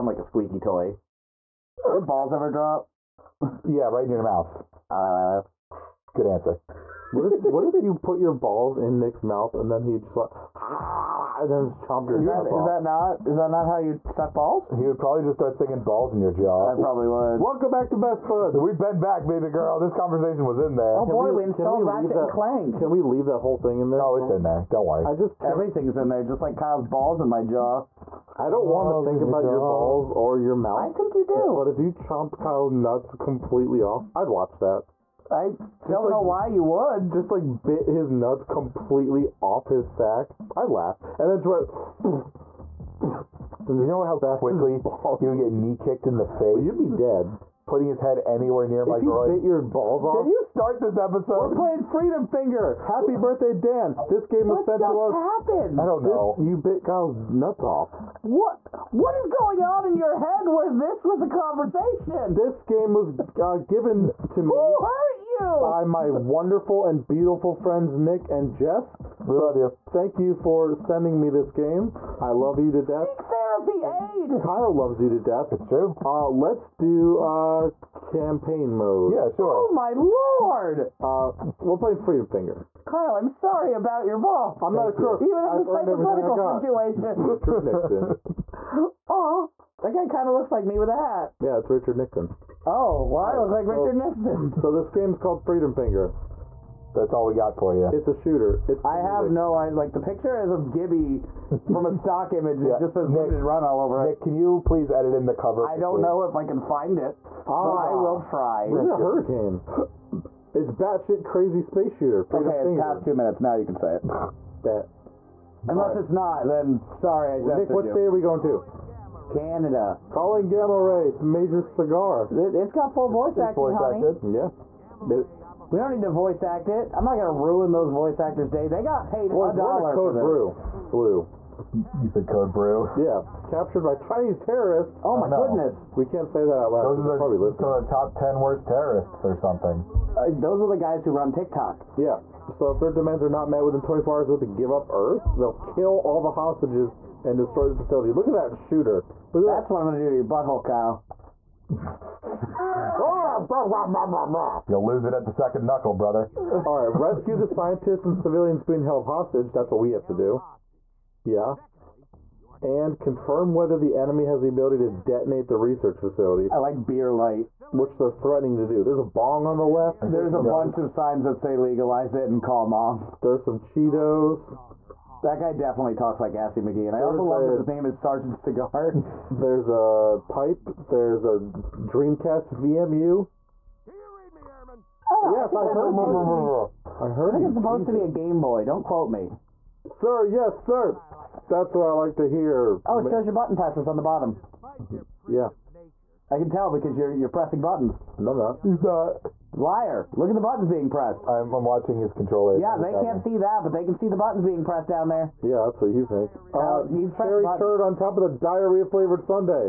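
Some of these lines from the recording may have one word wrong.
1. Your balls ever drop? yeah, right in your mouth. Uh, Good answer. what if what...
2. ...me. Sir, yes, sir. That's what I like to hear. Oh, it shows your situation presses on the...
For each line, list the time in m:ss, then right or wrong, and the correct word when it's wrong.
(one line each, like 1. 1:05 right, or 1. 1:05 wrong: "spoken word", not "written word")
1. 0:01 right
2. 3:09 wrong: "button", not "situation".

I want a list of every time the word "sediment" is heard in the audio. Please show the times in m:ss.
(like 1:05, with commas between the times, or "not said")
not said.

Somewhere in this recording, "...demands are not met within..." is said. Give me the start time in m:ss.
2:22.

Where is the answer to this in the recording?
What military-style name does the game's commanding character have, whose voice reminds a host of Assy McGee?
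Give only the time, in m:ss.
2:57.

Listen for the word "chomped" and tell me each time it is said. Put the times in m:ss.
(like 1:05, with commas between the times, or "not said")
0:11, 0:31.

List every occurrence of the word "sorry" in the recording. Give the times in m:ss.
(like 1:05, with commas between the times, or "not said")
1:23, 1:56.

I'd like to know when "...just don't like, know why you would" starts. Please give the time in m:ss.
0:35.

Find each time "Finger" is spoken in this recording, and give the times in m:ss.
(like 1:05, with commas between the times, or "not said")
0:52, 1:22, 1:35.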